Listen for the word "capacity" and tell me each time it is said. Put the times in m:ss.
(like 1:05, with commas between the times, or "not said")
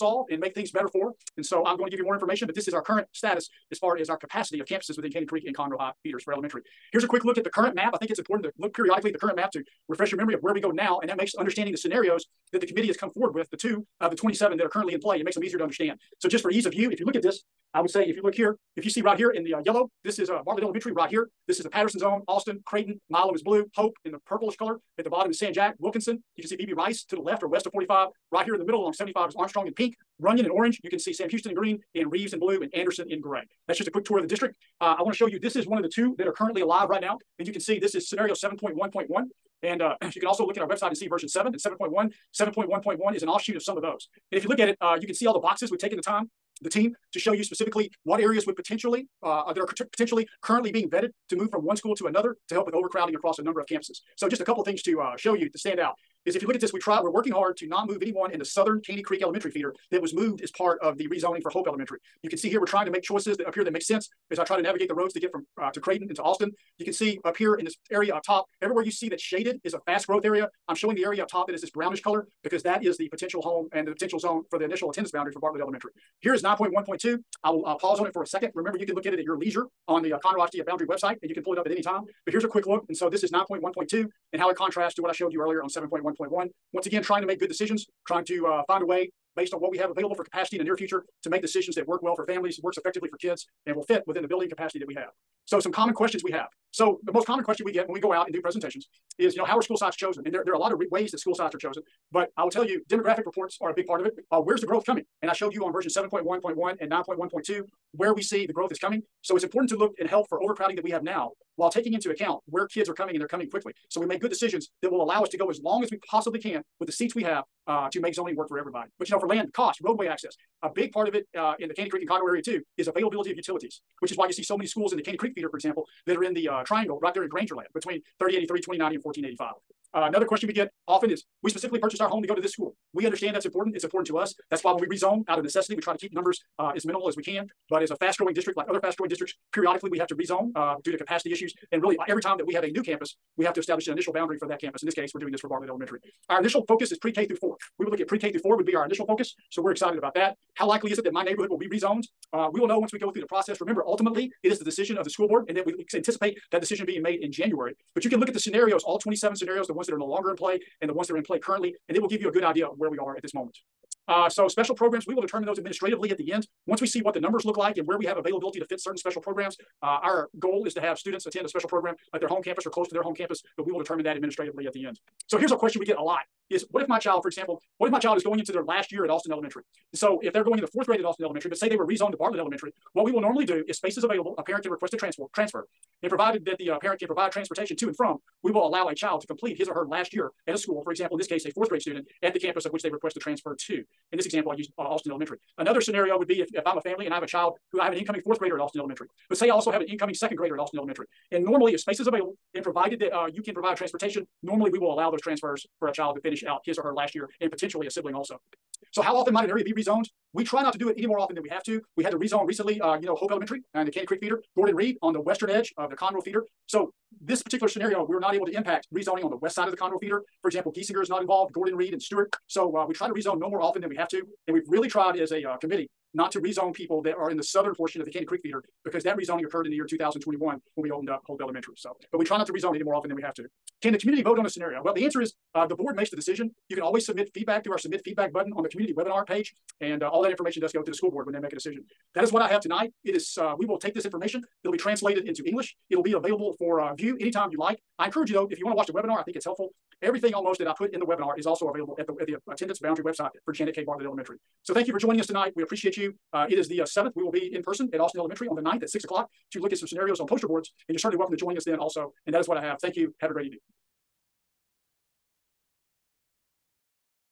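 0:04, 1:30, 1:34, 2:20.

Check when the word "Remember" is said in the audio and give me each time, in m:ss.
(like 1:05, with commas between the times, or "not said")
1:18, 2:33.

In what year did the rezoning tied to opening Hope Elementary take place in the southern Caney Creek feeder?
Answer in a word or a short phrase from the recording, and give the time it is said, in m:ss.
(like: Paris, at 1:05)
2021, at 3:49.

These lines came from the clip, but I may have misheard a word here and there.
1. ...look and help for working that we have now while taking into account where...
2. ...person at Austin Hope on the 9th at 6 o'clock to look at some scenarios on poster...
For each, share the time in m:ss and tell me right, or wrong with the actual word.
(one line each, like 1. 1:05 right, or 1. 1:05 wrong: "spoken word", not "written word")
1. 1:49 wrong: "overcrowding", not "working"
2. 4:17 wrong: "Elementary", not "Hope".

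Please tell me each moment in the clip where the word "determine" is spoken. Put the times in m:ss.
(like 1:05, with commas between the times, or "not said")
2:45, 2:53.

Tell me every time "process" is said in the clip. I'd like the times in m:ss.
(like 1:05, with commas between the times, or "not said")
2:33.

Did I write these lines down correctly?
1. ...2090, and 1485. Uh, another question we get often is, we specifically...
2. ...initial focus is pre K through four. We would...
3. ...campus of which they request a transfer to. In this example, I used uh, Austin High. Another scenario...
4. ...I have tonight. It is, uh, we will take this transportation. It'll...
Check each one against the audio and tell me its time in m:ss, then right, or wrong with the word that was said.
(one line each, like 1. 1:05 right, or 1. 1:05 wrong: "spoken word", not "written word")
1. 2:08 right
2. 2:26 right
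3. 3:12 wrong: "Elementary", not "High"
4. 4:02 wrong: "information", not "transportation".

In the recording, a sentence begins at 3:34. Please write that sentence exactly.
Gordon Reed on the western edge of the Conroe feeder.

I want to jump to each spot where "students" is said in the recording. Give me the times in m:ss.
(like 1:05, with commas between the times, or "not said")
2:50, 3:11.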